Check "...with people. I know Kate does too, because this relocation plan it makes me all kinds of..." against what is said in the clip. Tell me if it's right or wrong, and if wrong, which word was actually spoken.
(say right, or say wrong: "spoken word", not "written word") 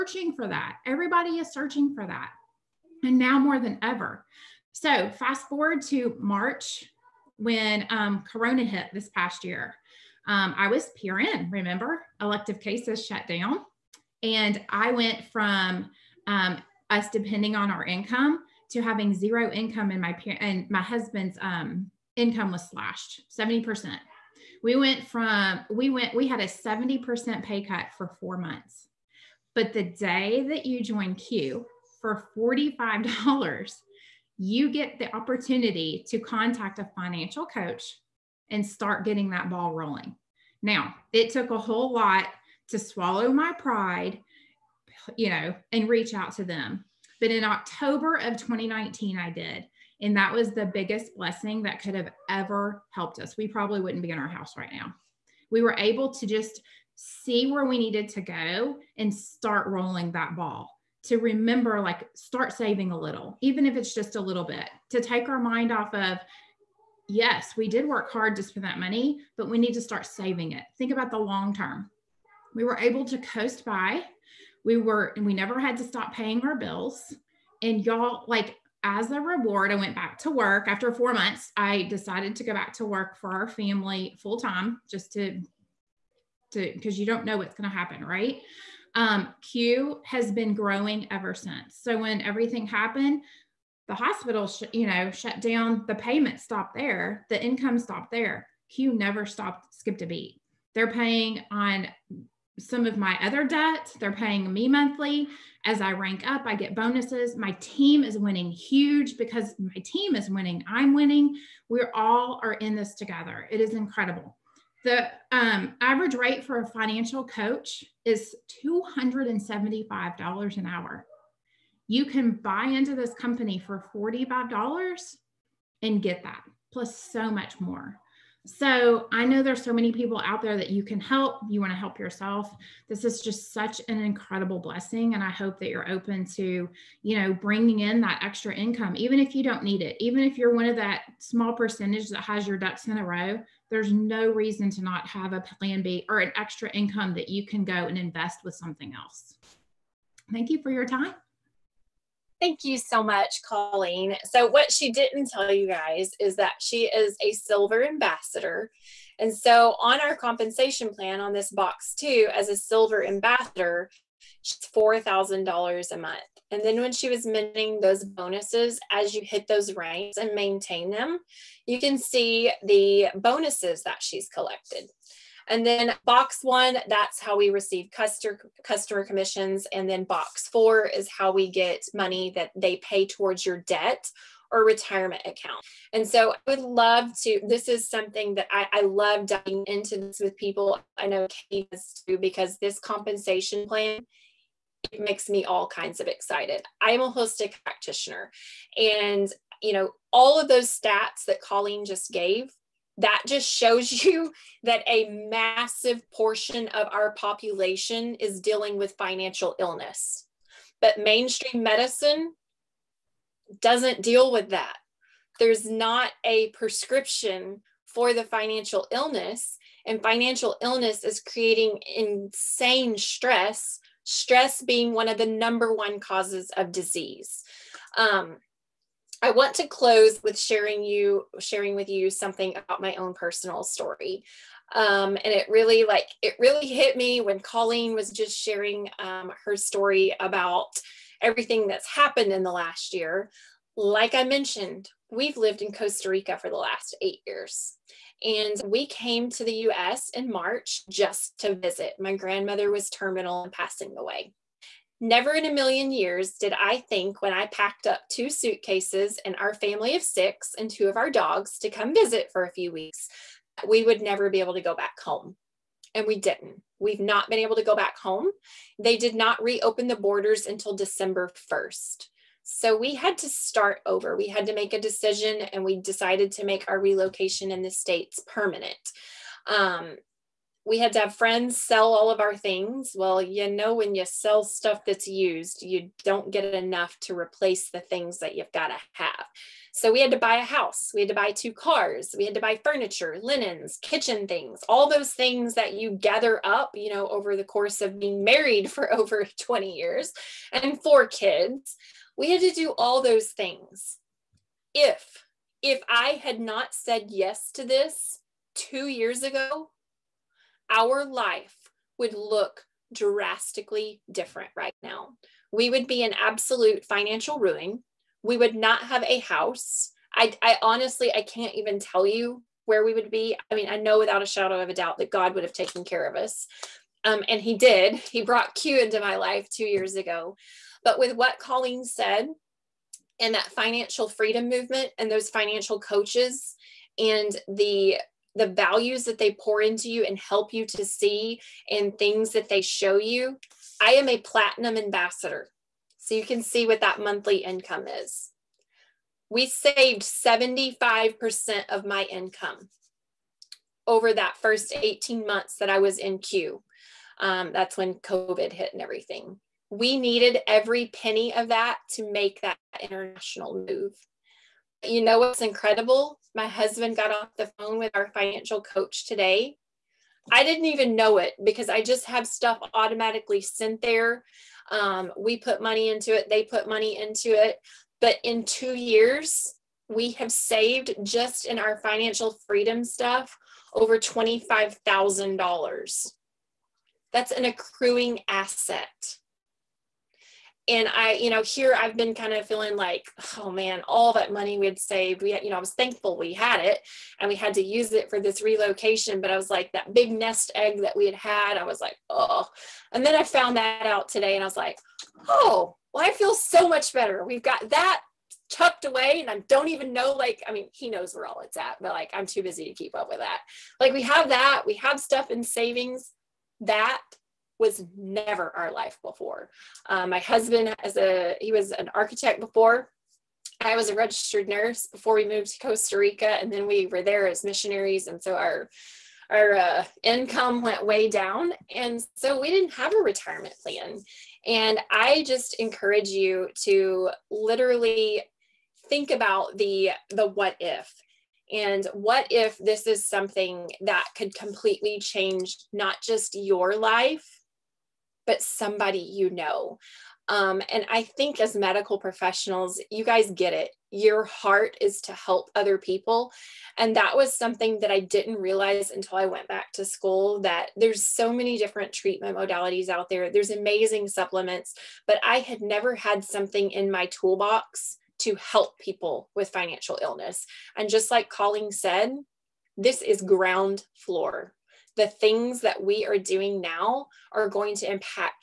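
wrong: "compensation", not "relocation".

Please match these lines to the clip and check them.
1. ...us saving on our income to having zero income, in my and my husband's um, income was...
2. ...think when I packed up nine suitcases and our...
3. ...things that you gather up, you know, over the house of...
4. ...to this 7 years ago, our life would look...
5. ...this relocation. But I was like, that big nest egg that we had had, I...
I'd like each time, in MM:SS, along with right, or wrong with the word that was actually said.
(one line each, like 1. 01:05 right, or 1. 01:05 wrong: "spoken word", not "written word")
1. 00:16 wrong: "depending", not "saving"
2. 04:16 wrong: "two", not "nine"
3. 04:55 wrong: "course", not "house"
4. 05:07 wrong: "2", not "7"
5. 06:38 right.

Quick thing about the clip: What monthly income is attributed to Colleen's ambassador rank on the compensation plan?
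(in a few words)
$4,000.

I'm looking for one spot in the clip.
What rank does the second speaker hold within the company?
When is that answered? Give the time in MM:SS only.
05:44.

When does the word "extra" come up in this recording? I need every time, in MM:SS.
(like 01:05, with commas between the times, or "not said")
02:18, 02:26.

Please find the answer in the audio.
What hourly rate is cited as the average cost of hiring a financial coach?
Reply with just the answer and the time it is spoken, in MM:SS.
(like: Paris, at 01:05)
$275, at 01:58.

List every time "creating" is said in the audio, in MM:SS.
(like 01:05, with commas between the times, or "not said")
03:41.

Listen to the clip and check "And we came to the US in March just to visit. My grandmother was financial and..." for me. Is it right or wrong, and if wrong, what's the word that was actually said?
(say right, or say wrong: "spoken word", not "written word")
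wrong: "terminal", not "financial".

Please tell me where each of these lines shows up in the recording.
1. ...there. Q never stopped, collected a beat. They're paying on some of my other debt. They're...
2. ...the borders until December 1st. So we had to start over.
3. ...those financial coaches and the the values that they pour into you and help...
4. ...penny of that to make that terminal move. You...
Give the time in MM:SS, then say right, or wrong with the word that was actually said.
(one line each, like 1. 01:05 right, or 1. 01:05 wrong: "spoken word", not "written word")
1. 01:38 wrong: "skipped", not "collected"
2. 04:29 right
3. 05:35 right
4. 06:00 wrong: "international", not "terminal".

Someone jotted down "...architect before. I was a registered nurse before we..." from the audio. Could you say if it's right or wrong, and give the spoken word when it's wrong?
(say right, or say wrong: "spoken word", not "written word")
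right.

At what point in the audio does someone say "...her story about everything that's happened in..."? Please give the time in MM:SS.
03:59.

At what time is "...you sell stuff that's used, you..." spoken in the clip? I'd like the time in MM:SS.
04:43.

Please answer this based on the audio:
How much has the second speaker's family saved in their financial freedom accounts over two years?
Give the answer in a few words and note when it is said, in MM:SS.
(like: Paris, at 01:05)
over $25,000, at 06:23.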